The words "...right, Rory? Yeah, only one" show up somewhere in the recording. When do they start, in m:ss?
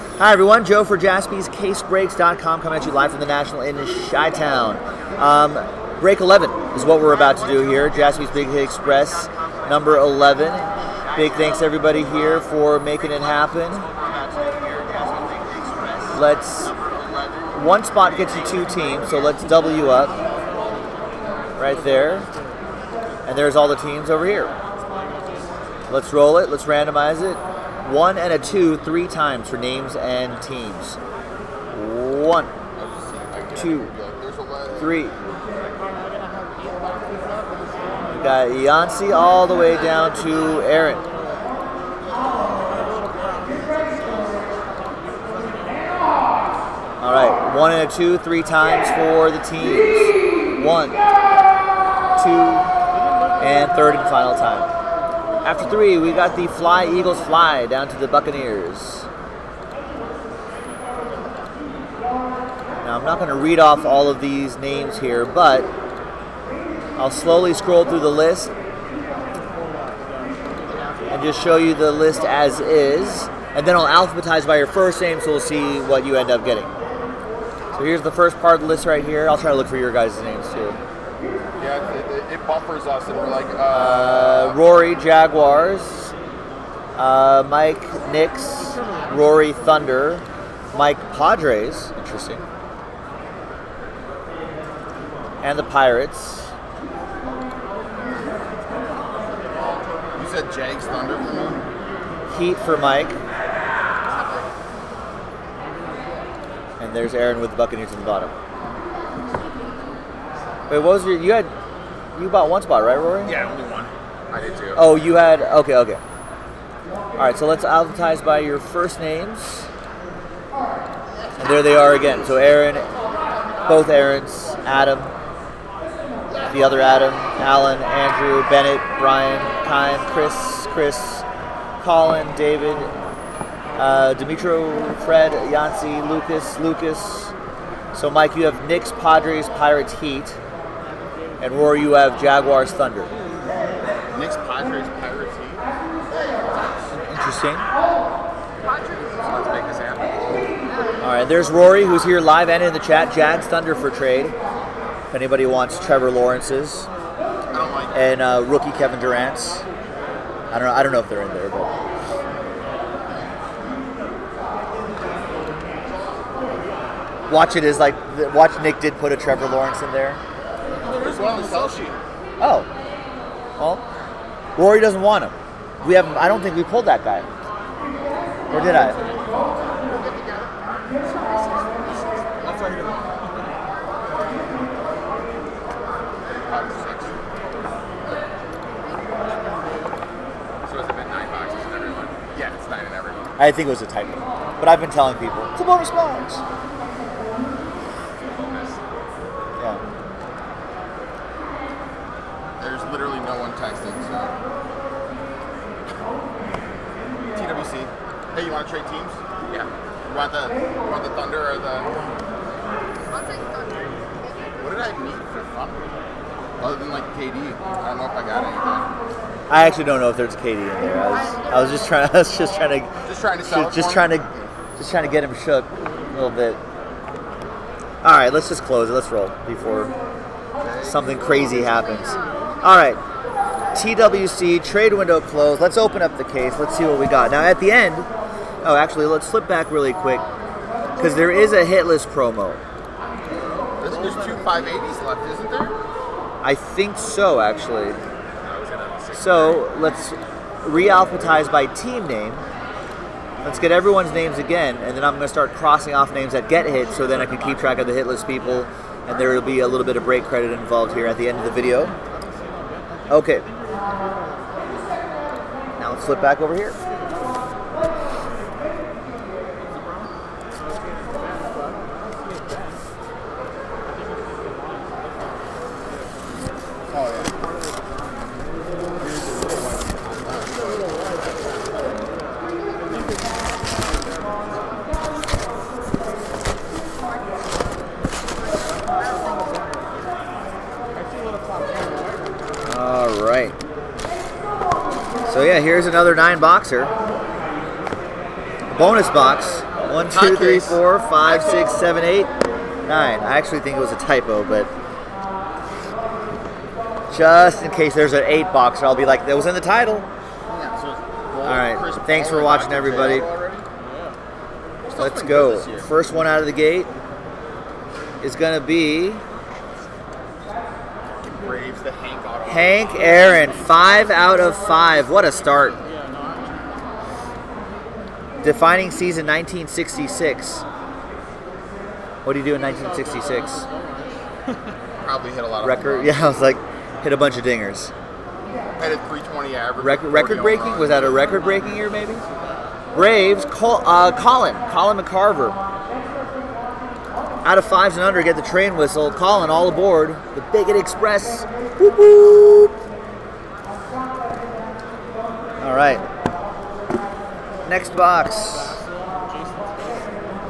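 1:52.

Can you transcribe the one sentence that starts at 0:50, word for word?
One, two, and third and final time.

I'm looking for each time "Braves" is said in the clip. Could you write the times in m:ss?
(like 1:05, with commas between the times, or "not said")
5:21, 5:42.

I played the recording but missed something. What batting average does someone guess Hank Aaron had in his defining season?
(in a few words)
320.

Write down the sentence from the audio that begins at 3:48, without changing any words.
All right, let's just close it.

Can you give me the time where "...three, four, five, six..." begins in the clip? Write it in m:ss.
5:00.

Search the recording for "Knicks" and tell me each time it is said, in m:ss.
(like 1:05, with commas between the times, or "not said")
1:28, 2:18.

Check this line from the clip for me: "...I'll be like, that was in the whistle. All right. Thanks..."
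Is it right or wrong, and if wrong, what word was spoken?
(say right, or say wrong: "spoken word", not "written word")
wrong: "title", not "whistle".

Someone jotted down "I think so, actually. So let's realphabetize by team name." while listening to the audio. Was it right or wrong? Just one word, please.
right.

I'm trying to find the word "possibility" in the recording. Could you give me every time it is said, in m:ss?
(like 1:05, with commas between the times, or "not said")
not said.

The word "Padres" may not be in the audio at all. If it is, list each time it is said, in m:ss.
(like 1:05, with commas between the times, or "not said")
1:31, 2:18, 2:24.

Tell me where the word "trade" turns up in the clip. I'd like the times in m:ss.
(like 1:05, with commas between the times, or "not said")
2:33, 3:54.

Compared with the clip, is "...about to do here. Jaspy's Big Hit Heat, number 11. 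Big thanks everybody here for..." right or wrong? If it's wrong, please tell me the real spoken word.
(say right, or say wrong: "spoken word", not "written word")
wrong: "Express", not "Heat".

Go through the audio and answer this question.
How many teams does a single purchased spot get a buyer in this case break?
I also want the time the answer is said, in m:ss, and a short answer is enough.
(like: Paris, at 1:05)
2, at 0:18.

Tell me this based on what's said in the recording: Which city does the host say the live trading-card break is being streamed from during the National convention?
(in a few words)
Chi Town.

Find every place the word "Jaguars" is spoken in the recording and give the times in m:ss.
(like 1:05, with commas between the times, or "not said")
1:24, 2:22.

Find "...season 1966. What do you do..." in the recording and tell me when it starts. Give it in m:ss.
5:28.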